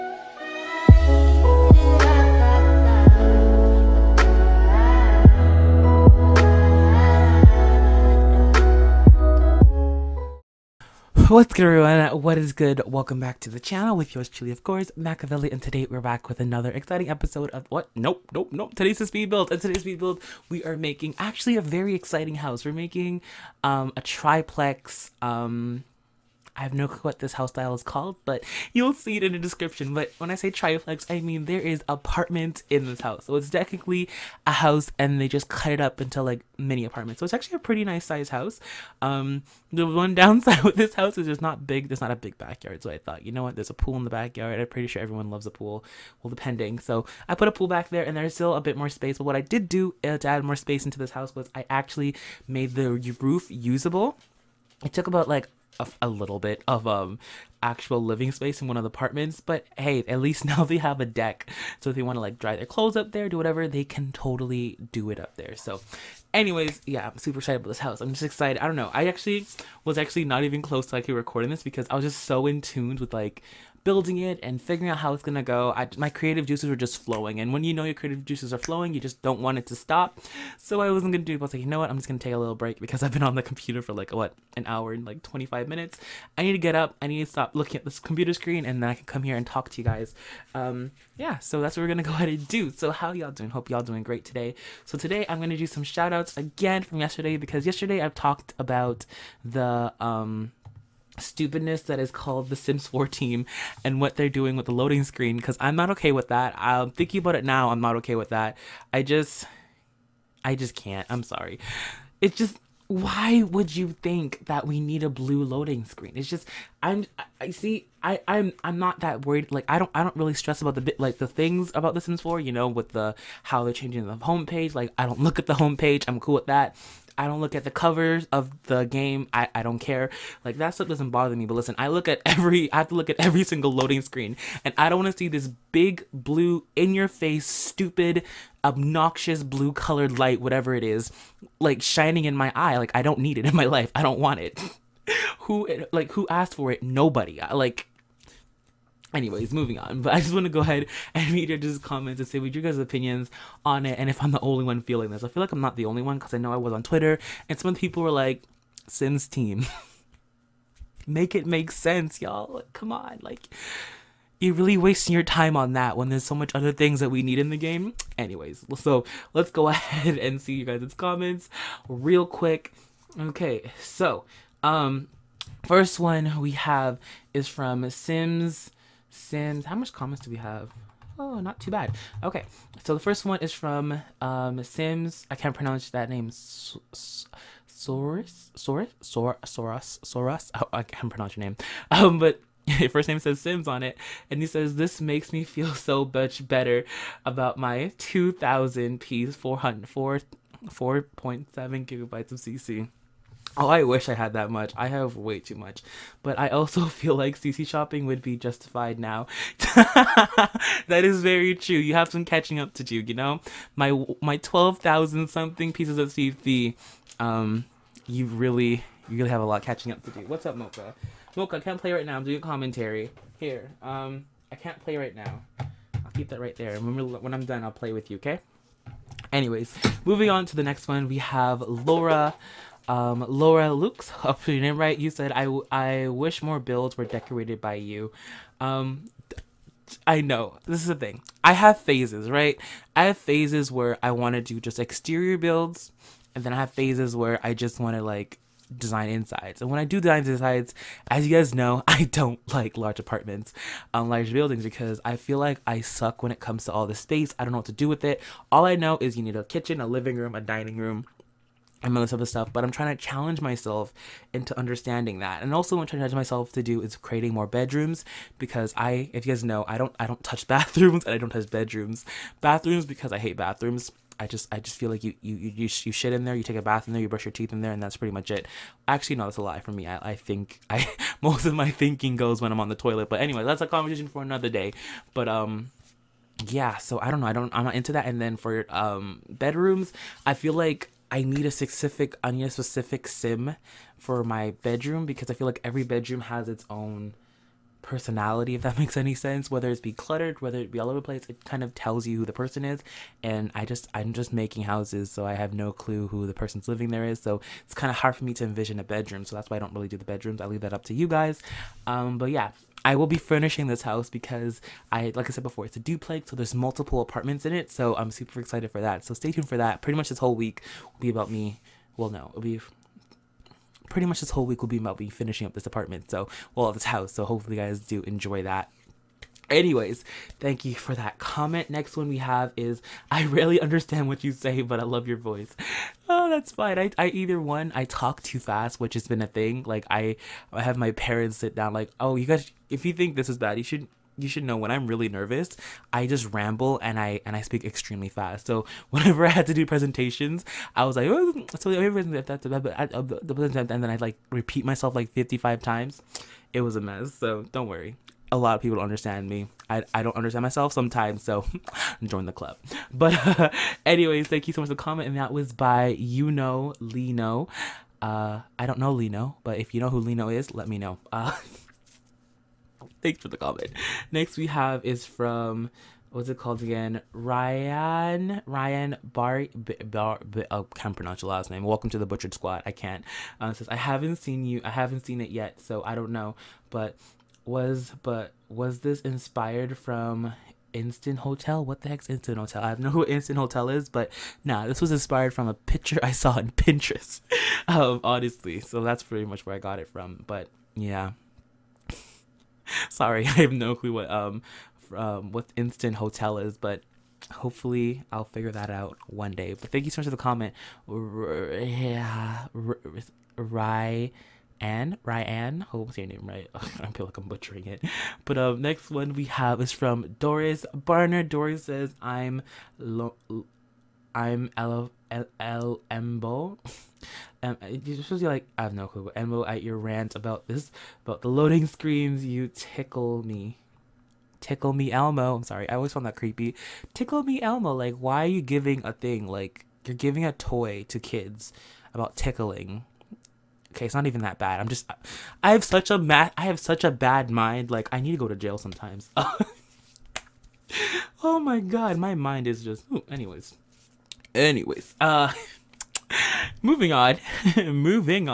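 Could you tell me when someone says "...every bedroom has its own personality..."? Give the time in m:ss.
4:55.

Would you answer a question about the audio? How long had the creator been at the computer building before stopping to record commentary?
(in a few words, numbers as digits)
An hour and 25 minutes.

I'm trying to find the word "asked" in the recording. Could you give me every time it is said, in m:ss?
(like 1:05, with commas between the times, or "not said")
2:26.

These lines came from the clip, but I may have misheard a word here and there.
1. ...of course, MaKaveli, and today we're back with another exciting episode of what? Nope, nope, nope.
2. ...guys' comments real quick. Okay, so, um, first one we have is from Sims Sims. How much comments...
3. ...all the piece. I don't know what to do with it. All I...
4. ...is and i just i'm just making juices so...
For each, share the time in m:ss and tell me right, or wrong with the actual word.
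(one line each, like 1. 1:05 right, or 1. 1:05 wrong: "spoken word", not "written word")
1. 0:14 right
2. 2:50 right
3. 4:16 wrong: "space", not "piece"
4. 5:02 wrong: "houses", not "juices".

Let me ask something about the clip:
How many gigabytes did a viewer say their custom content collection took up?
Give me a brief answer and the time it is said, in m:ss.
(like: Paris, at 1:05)
4.7, at 3:20.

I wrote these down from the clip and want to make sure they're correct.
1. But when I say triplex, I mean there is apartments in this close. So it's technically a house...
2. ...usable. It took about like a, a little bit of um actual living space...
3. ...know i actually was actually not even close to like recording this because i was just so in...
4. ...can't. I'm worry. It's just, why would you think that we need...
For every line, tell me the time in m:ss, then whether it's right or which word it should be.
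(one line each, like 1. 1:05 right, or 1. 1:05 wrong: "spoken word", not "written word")
1. 0:29 wrong: "house", not "close"
2. 0:53 right
3. 1:08 right
4. 1:50 wrong: "sorry", not "worry".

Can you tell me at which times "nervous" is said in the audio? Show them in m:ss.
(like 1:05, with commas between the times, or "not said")
5:45.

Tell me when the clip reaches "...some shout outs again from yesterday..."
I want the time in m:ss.
1:35.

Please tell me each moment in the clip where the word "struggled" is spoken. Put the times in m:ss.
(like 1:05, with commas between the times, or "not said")
not said.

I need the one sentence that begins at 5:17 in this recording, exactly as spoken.
So I'm super excited for that.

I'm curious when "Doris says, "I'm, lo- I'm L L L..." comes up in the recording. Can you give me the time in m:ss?
7:01.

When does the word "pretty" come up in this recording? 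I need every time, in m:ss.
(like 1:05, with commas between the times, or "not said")
0:37, 0:44, 4:37, 5:19, 5:23, 6:39.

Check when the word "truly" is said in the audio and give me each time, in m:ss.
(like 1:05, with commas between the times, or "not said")
0:14.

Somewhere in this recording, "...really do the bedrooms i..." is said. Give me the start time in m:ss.
5:09.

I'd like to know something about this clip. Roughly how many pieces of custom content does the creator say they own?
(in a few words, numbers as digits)
12,000.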